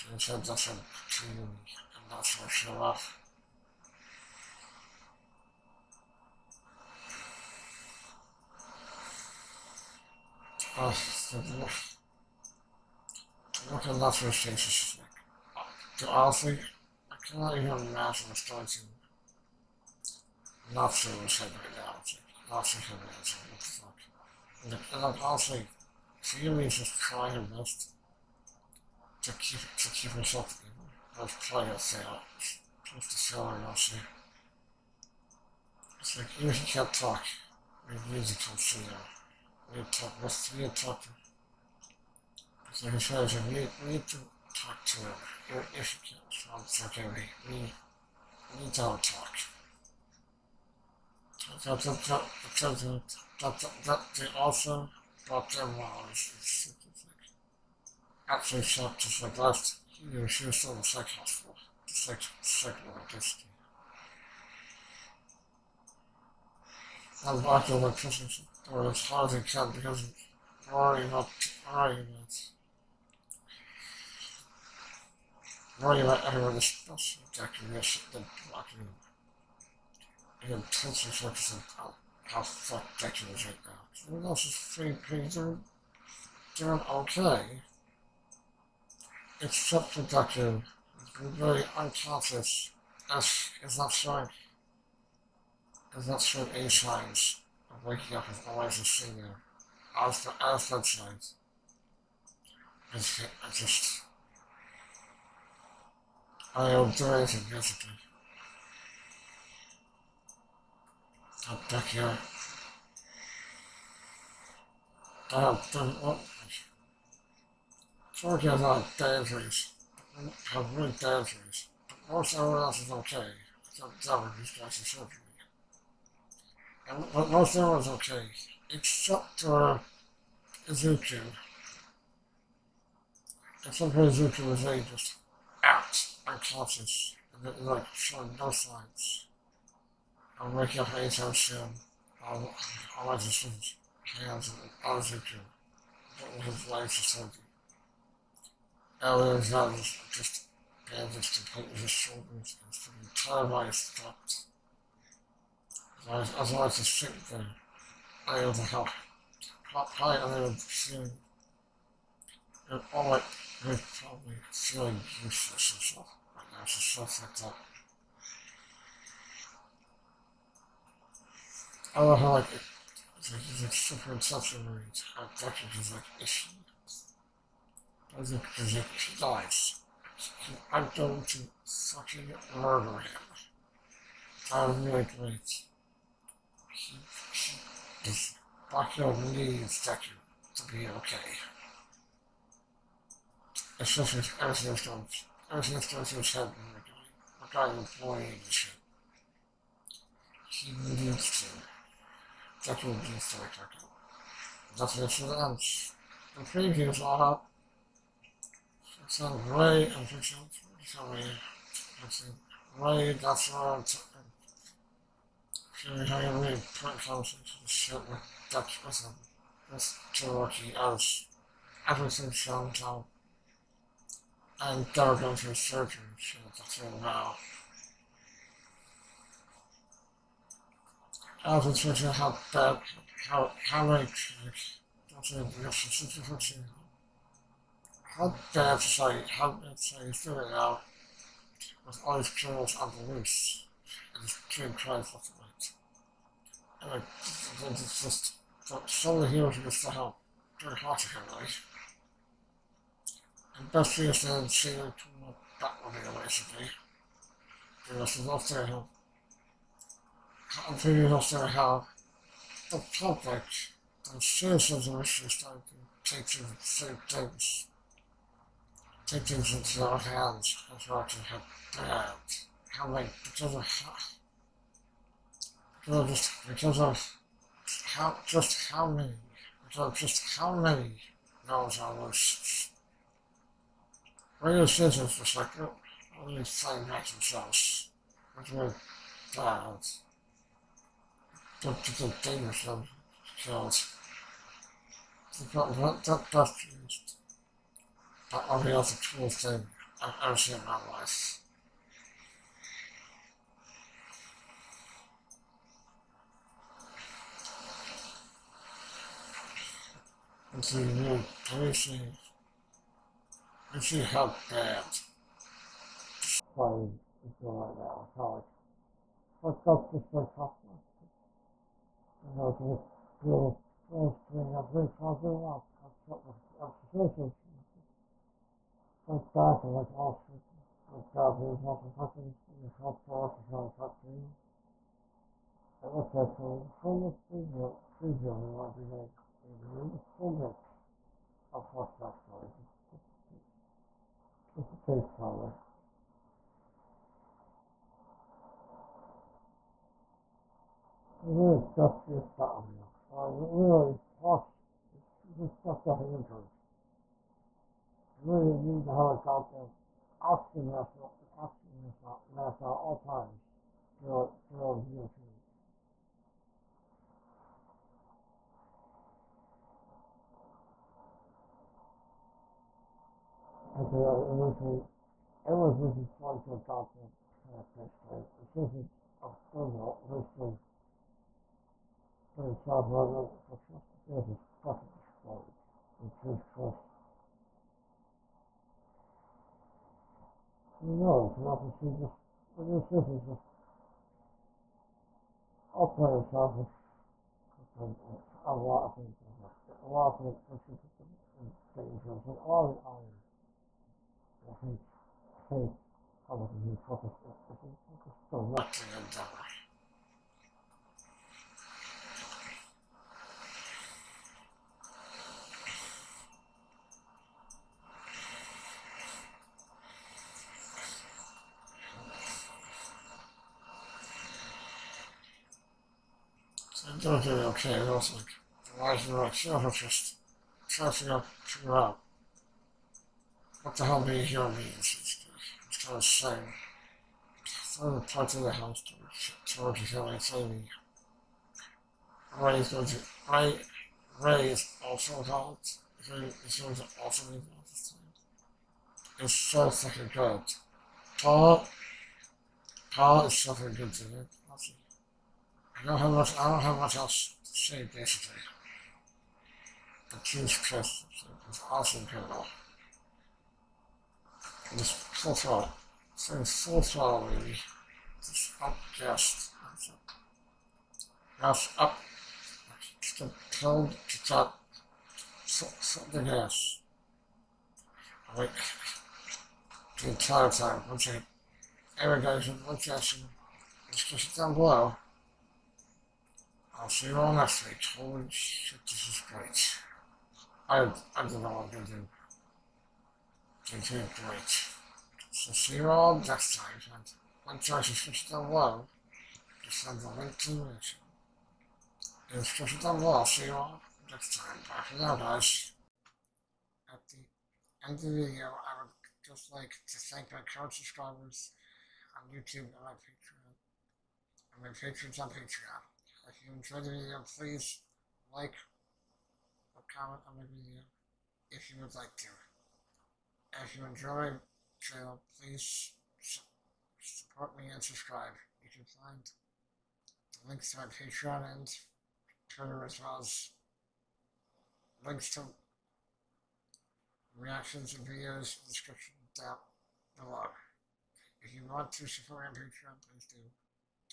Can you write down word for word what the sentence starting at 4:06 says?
And I think it's just that solely he was used to help, very hard to him, right?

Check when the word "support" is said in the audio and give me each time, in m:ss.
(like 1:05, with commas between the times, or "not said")
8:46, 9:02.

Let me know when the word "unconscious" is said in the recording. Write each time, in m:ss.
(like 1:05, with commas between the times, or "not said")
1:31, 2:16.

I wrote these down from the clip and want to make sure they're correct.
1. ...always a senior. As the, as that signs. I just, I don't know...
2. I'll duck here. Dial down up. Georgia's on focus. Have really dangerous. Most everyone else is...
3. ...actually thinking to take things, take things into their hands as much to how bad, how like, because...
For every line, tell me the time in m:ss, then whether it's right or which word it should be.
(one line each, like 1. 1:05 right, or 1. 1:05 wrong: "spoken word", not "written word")
1. 1:38 right
2. 1:51 wrong: "dangerous", not "focus"
3. 4:24 wrong: "starting", not "thinking".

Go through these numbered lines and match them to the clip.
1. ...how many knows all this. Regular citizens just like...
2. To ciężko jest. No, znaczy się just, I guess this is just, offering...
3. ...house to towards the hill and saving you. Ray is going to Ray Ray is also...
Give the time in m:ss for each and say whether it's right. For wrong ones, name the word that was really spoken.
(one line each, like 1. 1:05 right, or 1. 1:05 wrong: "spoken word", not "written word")
1. 4:40 right
2. 6:25 right
3. 7:18 right.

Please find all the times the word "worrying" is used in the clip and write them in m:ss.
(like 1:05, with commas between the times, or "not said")
1:10, 1:15.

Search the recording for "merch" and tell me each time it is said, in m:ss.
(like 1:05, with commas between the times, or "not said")
not said.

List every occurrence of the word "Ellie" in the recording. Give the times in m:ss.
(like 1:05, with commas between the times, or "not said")
2:29.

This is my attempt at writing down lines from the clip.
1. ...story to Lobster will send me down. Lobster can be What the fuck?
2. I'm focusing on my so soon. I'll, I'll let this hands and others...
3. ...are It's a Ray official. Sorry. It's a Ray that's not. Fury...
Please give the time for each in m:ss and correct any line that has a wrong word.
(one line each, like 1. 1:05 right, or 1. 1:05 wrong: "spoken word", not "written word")
1. 0:18 right
2. 2:20 wrong: "working", not "focusing"
3. 3:27 right.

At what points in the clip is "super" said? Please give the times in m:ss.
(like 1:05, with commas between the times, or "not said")
2:53, 5:54.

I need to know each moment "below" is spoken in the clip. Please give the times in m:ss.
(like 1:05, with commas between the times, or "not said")
8:04, 9:00.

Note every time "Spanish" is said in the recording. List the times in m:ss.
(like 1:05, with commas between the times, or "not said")
not said.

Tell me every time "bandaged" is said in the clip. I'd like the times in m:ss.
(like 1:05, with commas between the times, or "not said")
2:30.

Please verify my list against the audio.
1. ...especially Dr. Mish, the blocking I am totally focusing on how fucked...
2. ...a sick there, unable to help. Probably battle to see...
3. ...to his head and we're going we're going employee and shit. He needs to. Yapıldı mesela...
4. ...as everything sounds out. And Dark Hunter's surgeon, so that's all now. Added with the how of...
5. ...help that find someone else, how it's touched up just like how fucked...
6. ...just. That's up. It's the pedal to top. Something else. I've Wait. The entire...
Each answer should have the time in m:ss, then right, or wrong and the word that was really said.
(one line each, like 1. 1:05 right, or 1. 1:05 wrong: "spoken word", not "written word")
1. 1:16 right
2. 2:36 wrong: "unable", not "battle"
3. 3:16 right
4. 3:40 right
5. 5:14 wrong: "fucked", not "touched"
6. 7:48 right.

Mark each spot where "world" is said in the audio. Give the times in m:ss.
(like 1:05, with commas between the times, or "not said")
8:18, 8:22.